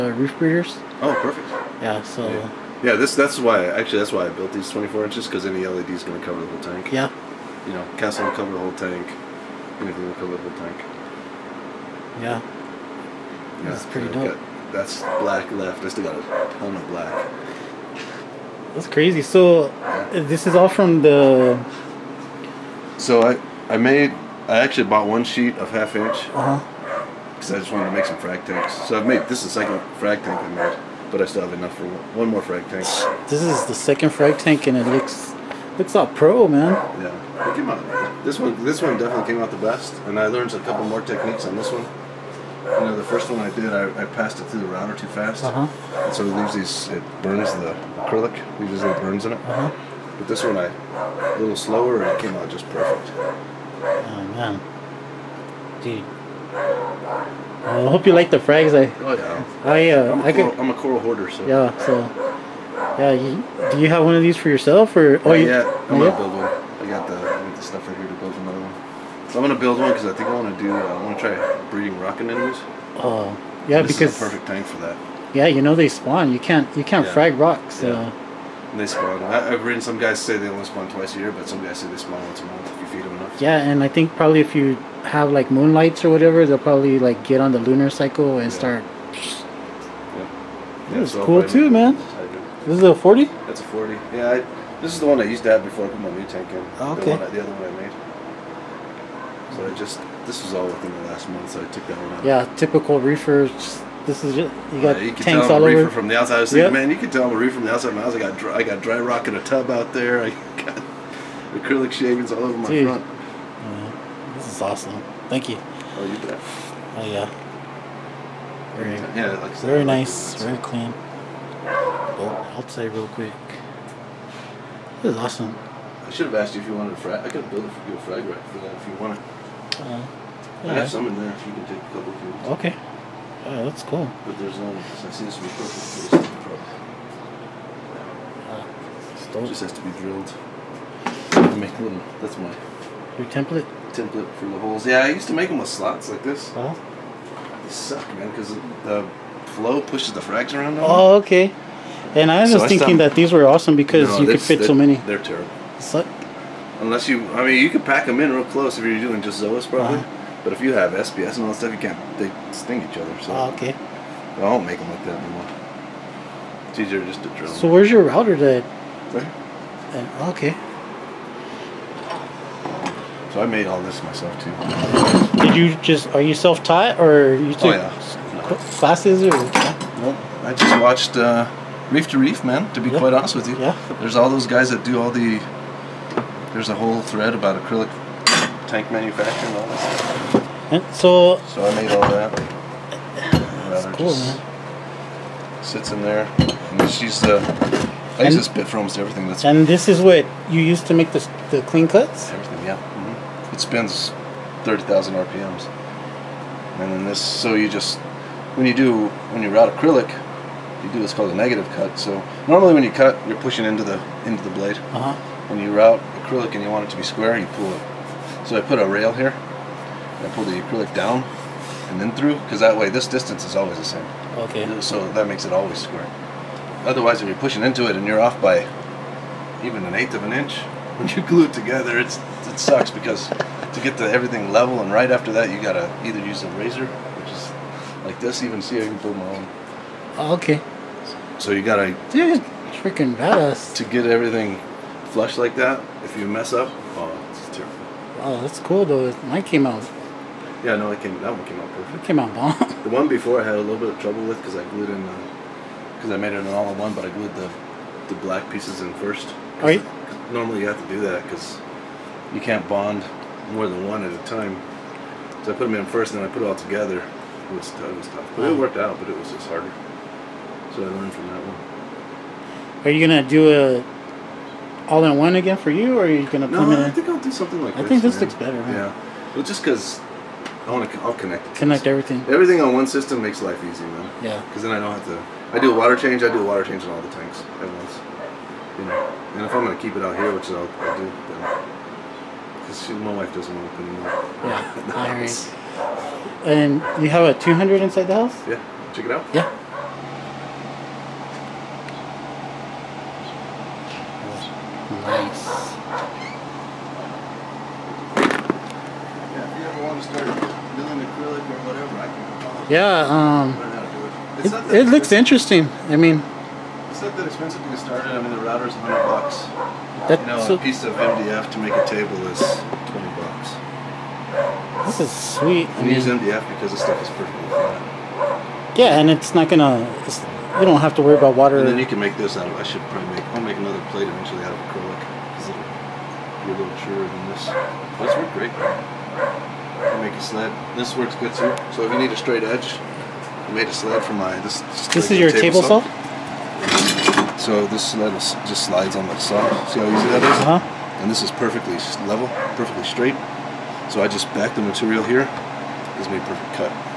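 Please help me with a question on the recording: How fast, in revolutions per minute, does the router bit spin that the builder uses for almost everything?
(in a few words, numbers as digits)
30,000.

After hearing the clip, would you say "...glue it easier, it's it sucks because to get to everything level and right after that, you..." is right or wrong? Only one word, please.
wrong.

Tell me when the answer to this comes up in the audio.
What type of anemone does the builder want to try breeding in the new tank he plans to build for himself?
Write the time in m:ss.
1:11.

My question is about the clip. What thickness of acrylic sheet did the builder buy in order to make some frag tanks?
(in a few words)
half inch.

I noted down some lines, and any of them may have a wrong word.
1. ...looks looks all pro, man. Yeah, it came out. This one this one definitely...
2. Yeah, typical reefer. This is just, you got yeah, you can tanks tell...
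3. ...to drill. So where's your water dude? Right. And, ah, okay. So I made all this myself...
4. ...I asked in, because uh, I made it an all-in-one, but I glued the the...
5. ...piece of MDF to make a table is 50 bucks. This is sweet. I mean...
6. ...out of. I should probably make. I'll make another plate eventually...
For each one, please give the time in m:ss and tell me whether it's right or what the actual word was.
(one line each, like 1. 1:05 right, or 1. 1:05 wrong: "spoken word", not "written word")
1. 0:34 right
2. 1:42 right
3. 2:47 wrong: "router", not "water"
4. 4:14 wrong: "glued", not "asked"
5. 5:20 wrong: "20", not "50"
6. 5:32 right.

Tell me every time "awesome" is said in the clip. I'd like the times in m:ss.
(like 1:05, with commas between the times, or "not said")
1:54, 2:05, 2:33.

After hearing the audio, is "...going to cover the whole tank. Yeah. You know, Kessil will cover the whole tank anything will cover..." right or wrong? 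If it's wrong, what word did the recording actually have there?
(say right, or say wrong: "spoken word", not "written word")
right.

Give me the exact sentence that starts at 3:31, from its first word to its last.
So normally when you cut, you're pushing into the into the blade.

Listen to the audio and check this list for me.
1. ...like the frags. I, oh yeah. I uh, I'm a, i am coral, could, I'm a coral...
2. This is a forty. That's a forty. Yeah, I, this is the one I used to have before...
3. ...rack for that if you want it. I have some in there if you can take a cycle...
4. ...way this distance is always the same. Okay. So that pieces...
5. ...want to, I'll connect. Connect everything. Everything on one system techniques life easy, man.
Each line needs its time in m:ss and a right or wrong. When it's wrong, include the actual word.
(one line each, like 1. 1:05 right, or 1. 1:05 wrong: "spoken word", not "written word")
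1. 0:58 right
2. 1:32 right
3. 2:08 wrong: "couple", not "cycle"
4. 3:42 wrong: "makes", not "pieces"
5. 4:40 wrong: "makes", not "techniques".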